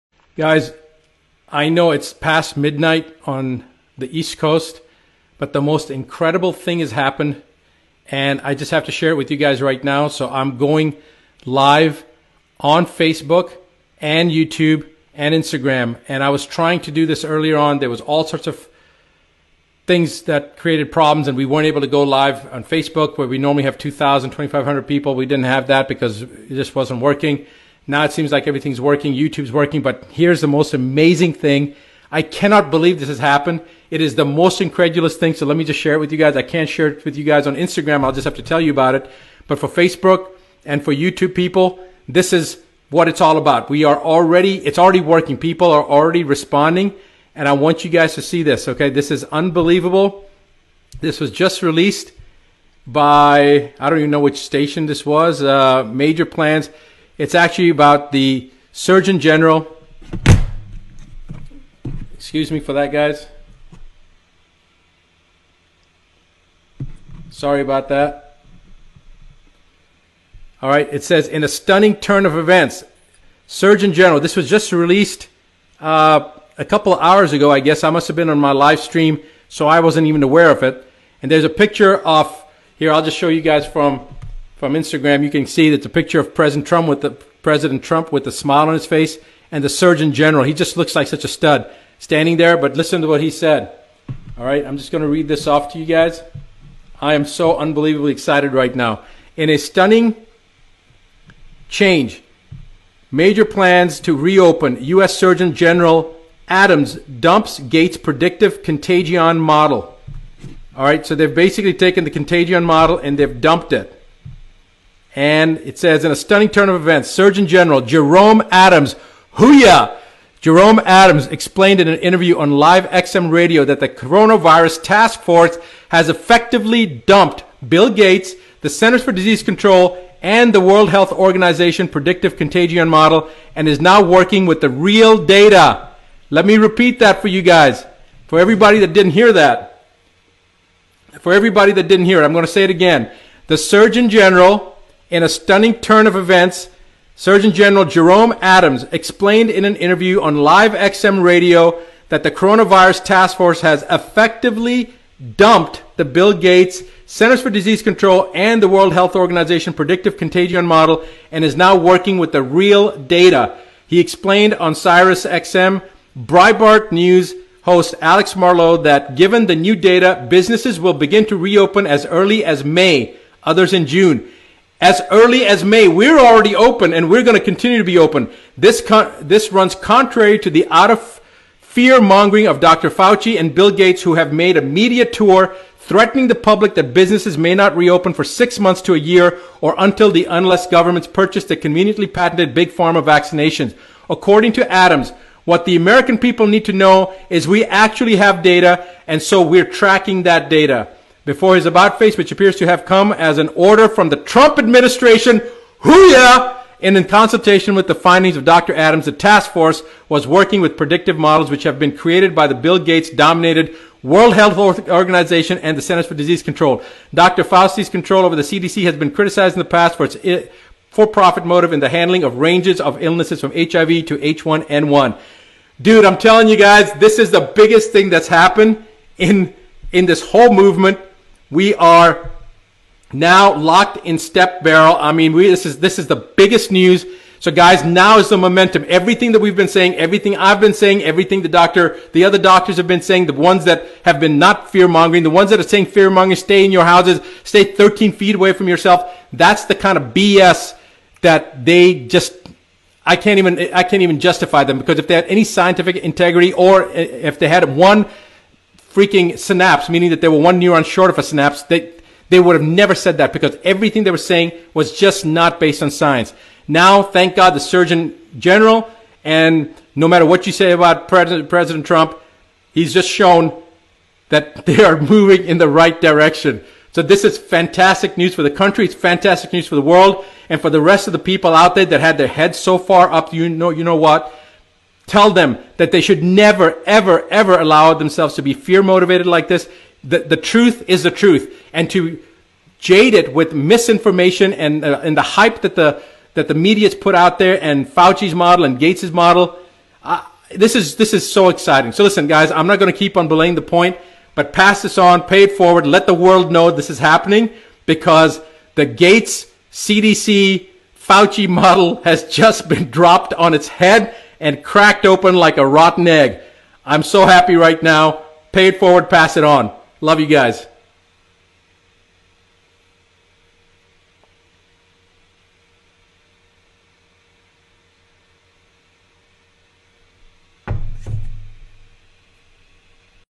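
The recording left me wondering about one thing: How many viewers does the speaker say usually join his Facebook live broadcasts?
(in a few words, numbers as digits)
2,000 to 2,500.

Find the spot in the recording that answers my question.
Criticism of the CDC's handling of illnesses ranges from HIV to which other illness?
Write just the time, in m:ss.
3:44.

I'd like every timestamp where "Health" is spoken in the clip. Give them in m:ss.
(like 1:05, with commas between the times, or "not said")
2:10, 2:38, 3:34.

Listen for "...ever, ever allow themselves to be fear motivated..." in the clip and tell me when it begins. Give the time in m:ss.
4:46.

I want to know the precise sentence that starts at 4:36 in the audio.
So this is fantastic news for the country.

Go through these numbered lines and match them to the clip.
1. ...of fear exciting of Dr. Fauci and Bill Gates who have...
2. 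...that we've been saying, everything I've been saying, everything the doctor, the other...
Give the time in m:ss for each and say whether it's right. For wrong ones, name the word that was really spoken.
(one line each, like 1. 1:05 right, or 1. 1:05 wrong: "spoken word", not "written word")
1. 3:00 wrong: "mongering", not "exciting"
2. 3:59 right.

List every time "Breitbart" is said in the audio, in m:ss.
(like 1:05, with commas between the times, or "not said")
2:46.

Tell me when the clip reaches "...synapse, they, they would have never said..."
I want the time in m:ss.
4:21.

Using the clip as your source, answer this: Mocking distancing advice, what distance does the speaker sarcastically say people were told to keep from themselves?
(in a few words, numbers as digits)
13 feet.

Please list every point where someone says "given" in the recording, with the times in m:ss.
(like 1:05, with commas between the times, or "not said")
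2:49.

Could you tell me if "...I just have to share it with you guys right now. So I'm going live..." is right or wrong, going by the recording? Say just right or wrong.
right.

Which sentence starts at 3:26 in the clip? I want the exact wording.
And in consultation with the findings of Dr.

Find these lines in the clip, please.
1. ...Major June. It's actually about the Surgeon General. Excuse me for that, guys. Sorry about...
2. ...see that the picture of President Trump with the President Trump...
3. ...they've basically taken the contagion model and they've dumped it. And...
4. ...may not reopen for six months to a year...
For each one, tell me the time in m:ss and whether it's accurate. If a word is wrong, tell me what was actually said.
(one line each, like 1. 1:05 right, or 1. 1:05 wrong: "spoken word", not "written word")
1. 0:55 wrong: "Plans", not "June"
2. 1:25 right
3. 1:51 right
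4. 3:07 right.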